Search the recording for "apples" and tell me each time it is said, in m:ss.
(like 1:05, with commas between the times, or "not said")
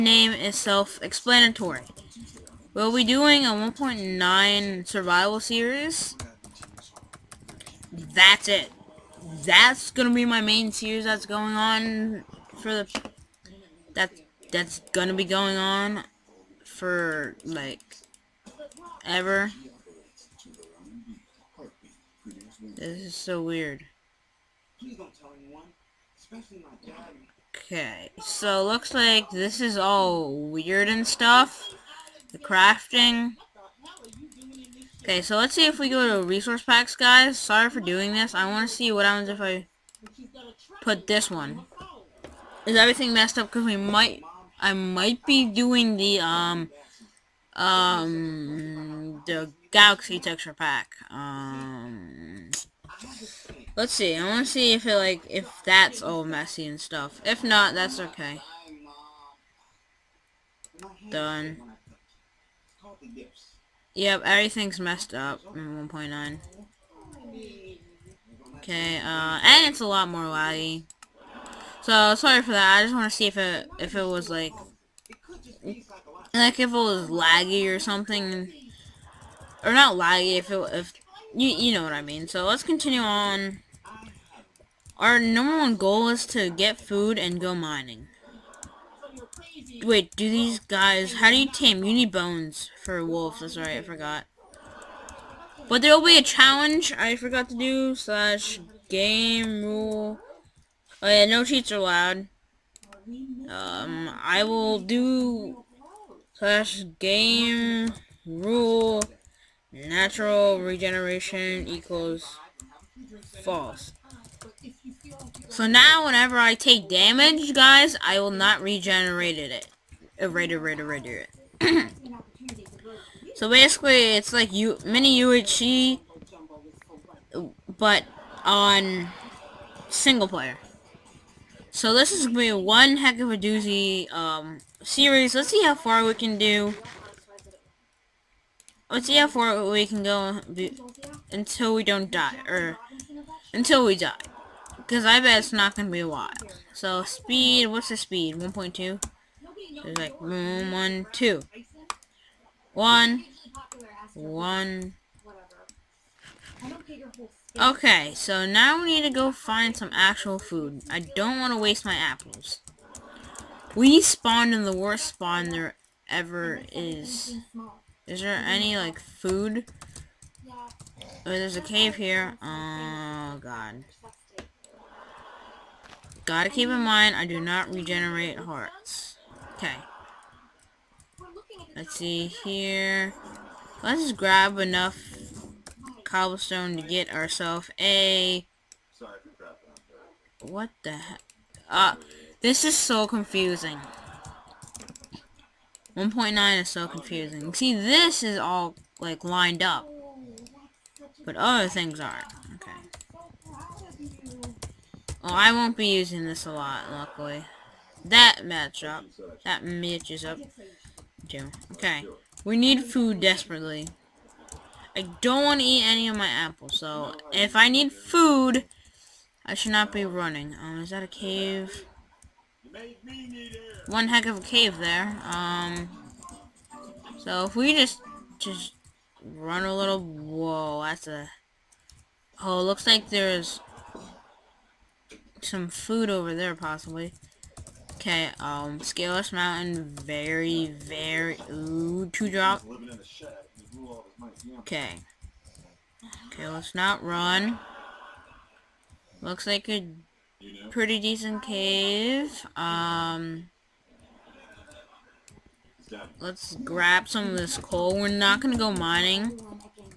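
2:41, 3:36.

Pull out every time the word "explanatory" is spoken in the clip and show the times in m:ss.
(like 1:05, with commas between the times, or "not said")
0:00.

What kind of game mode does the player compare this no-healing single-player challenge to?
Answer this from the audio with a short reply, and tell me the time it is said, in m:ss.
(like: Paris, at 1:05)
UHC, at 2:05.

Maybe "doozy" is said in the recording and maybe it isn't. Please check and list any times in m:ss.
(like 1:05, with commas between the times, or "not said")
2:13.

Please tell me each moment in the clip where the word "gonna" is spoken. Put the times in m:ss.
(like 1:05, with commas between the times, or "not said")
0:14, 4:18.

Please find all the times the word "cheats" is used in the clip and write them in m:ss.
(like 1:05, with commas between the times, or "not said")
1:41.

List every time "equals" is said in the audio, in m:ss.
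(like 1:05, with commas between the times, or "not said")
1:51.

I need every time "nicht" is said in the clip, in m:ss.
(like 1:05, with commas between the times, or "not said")
not said.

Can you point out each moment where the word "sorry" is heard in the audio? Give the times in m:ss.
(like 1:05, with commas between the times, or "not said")
0:37, 1:12.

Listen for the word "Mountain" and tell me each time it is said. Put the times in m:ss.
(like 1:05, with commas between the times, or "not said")
3:59.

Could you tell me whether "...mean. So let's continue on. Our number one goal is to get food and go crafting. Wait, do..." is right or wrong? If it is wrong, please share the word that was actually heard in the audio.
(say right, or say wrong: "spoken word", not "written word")
wrong: "mining", not "crafting".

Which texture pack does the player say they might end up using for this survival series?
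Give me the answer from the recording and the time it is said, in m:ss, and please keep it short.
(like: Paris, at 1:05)
Galaxy texture pack, at 0:49.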